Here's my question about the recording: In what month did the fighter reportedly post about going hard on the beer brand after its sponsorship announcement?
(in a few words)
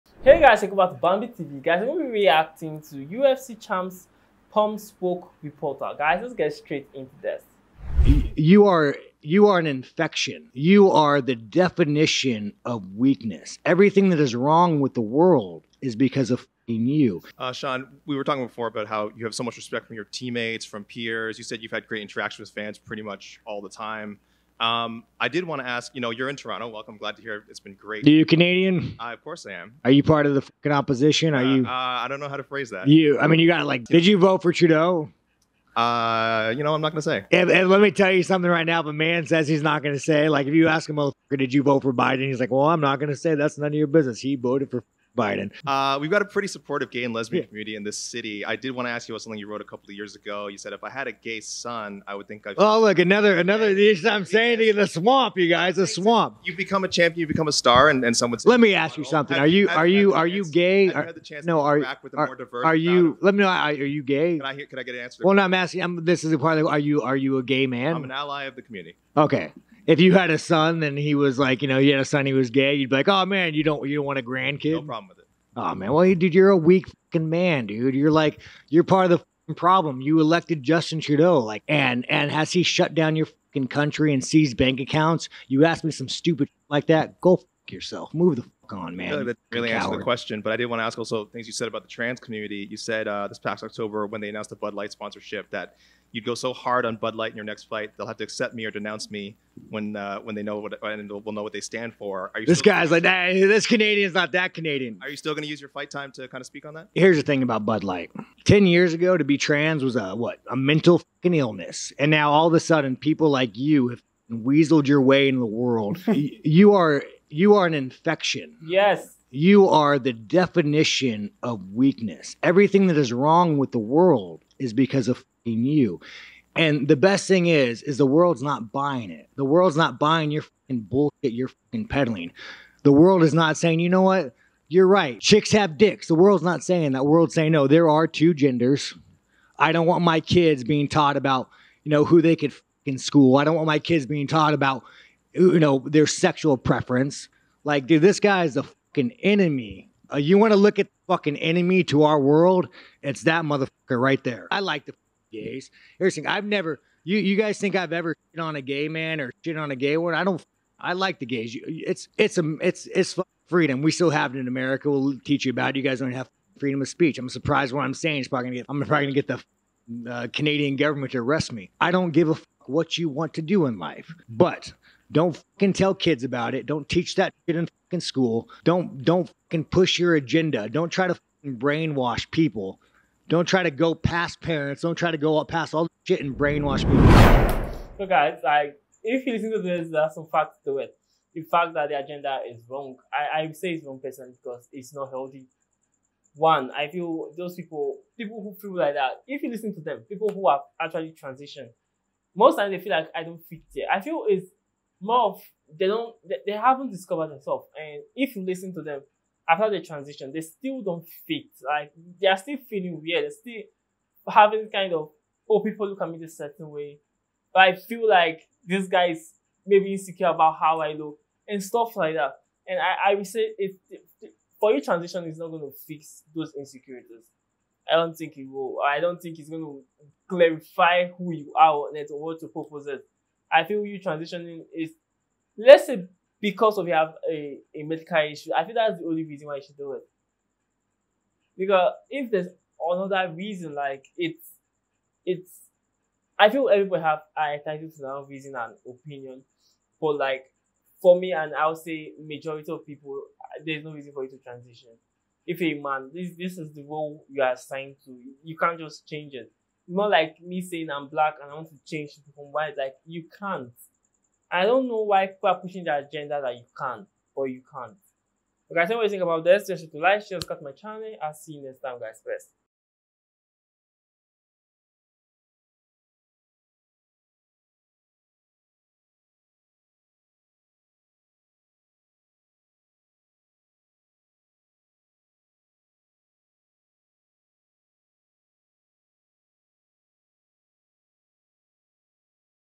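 October.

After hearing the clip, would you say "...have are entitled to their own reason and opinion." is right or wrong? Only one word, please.
right.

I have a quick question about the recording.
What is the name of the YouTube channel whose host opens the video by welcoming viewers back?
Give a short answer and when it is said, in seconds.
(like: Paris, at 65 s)
Bambi TV, at 1 s.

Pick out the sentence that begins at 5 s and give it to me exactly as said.
Guys, let's get straight into this.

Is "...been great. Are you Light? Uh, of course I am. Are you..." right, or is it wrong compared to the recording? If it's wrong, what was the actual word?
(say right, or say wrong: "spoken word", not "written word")
wrong: "Canadian", not "Light".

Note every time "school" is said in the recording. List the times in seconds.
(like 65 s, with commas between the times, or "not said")
142 s, 178 s.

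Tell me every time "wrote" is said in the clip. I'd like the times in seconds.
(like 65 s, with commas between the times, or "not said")
49 s.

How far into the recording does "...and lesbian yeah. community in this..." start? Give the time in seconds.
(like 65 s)
47 s.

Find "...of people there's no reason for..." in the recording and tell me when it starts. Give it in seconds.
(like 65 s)
252 s.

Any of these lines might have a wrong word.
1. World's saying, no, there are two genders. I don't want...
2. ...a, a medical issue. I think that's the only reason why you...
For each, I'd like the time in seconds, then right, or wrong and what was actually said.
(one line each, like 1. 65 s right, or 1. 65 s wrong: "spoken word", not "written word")
1. 137 s right
2. 237 s right.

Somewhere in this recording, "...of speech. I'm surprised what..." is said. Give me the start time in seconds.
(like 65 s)
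166 s.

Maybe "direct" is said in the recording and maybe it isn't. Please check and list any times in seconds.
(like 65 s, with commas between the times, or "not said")
not said.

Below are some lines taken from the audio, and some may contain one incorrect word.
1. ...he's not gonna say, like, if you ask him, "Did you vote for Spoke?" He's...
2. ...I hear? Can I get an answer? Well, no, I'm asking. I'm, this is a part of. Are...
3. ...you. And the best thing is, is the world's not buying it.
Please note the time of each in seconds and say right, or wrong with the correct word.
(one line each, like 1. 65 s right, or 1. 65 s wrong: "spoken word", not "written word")
1. 39 s wrong: "Biden", not "Spoke"
2. 64 s right
3. 125 s right.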